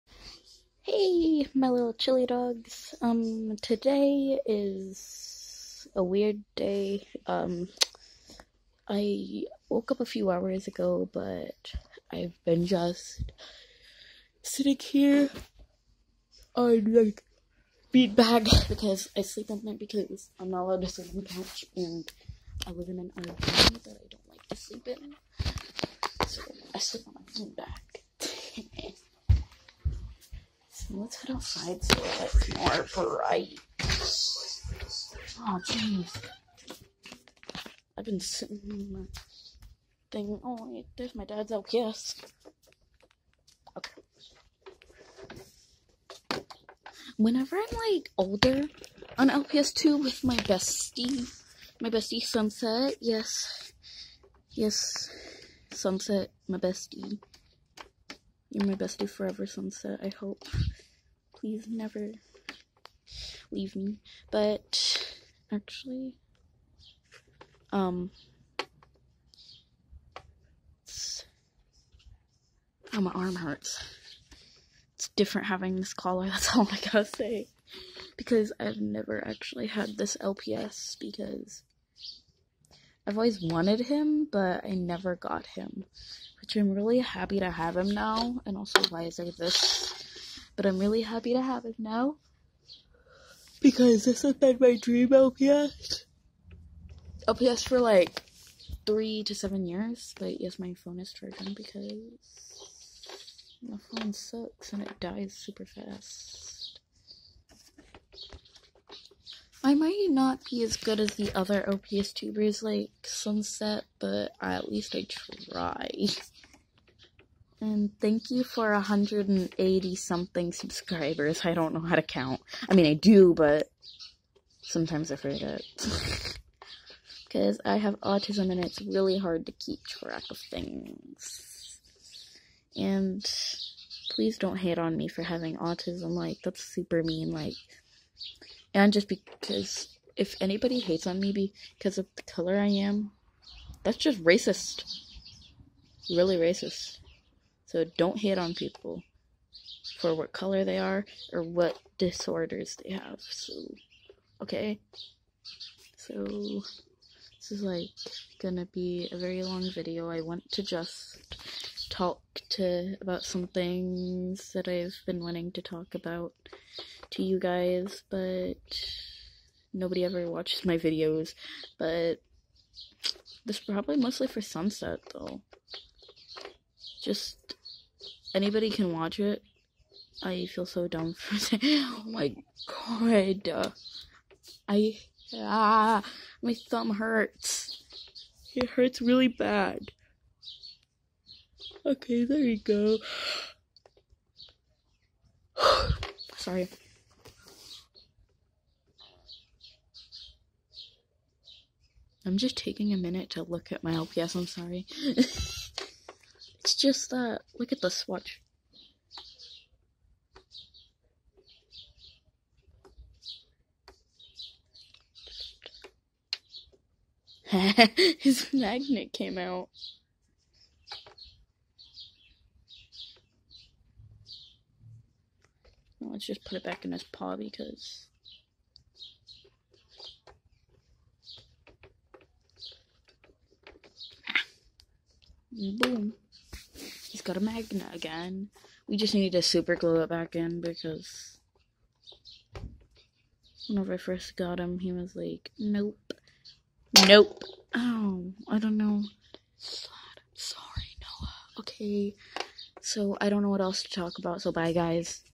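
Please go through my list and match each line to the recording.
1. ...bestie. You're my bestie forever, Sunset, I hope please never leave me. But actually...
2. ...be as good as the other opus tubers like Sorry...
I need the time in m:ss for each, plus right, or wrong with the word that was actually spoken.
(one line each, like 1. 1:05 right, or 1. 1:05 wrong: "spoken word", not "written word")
1. 0:56 right
2. 1:50 wrong: "Sunset", not "Sorry".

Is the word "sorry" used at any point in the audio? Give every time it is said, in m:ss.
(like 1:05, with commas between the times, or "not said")
3:16, 3:24, 4:09.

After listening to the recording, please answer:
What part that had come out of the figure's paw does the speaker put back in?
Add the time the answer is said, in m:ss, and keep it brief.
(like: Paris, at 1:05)
magnet, at 3:38.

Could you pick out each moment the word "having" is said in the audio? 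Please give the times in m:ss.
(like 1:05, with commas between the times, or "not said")
1:15, 2:15.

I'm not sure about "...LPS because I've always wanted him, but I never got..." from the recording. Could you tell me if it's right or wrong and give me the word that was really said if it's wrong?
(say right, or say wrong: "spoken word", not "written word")
right.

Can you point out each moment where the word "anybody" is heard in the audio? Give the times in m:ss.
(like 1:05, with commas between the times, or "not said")
2:20, 2:58.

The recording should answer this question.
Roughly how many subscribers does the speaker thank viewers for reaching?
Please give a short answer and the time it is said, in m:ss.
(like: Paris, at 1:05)
180, at 1:58.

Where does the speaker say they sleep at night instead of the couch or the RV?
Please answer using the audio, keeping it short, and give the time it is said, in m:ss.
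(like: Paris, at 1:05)
bean bag, at 0:27.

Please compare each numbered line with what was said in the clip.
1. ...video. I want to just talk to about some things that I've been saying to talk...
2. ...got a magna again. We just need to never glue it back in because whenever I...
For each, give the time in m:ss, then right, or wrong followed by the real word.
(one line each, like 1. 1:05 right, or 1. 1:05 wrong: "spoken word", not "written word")
1. 2:39 wrong: "wanting", not "saying"
2. 3:57 wrong: "super", not "never".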